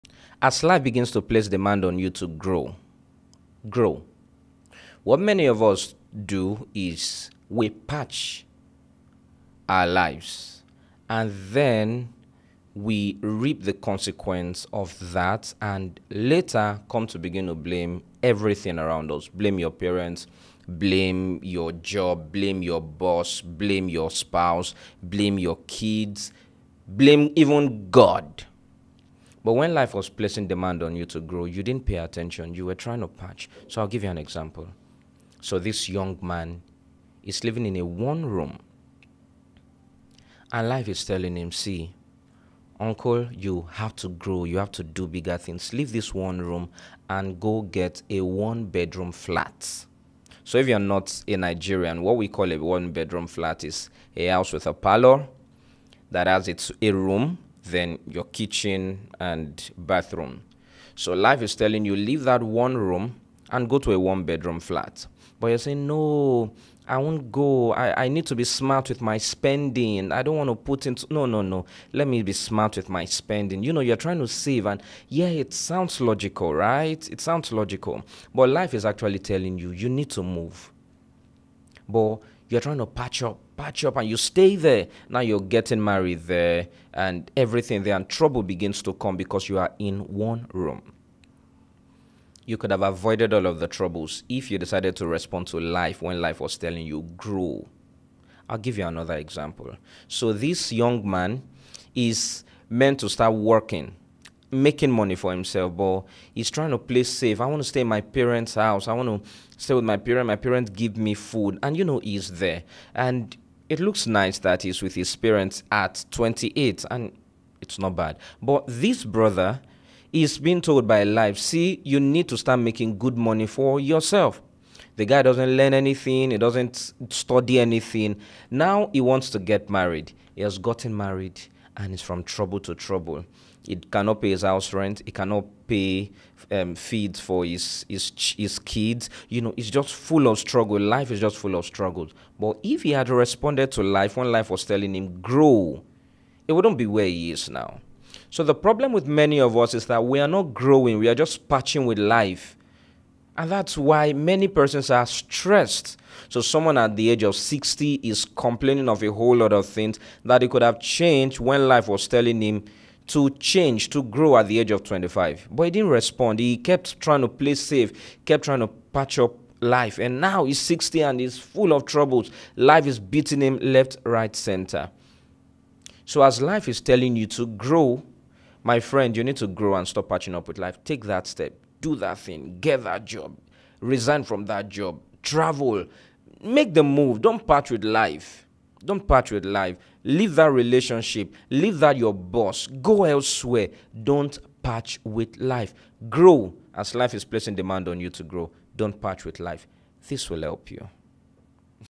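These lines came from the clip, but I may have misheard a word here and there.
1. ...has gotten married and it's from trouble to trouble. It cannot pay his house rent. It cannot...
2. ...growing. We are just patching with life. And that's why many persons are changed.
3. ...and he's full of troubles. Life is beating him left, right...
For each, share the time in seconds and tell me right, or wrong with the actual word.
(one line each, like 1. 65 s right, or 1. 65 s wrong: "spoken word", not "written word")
1. 130 s right
2. 150 s wrong: "stressed", not "changed"
3. 171 s right.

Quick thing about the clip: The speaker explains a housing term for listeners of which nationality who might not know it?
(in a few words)
Nigerian.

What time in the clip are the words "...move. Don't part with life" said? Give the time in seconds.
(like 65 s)
186 s.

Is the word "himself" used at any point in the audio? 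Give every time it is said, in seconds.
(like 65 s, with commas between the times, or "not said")
105 s.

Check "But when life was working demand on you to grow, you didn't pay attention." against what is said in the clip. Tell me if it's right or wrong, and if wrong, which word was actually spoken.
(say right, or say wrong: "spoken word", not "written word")
wrong: "placing", not "working".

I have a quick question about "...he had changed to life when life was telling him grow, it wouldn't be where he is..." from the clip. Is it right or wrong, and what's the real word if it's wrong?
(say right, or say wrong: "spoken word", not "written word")
wrong: "responded", not "changed".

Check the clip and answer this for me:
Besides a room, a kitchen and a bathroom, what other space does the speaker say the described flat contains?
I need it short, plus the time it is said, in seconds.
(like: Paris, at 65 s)
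Parlor, at 54 s.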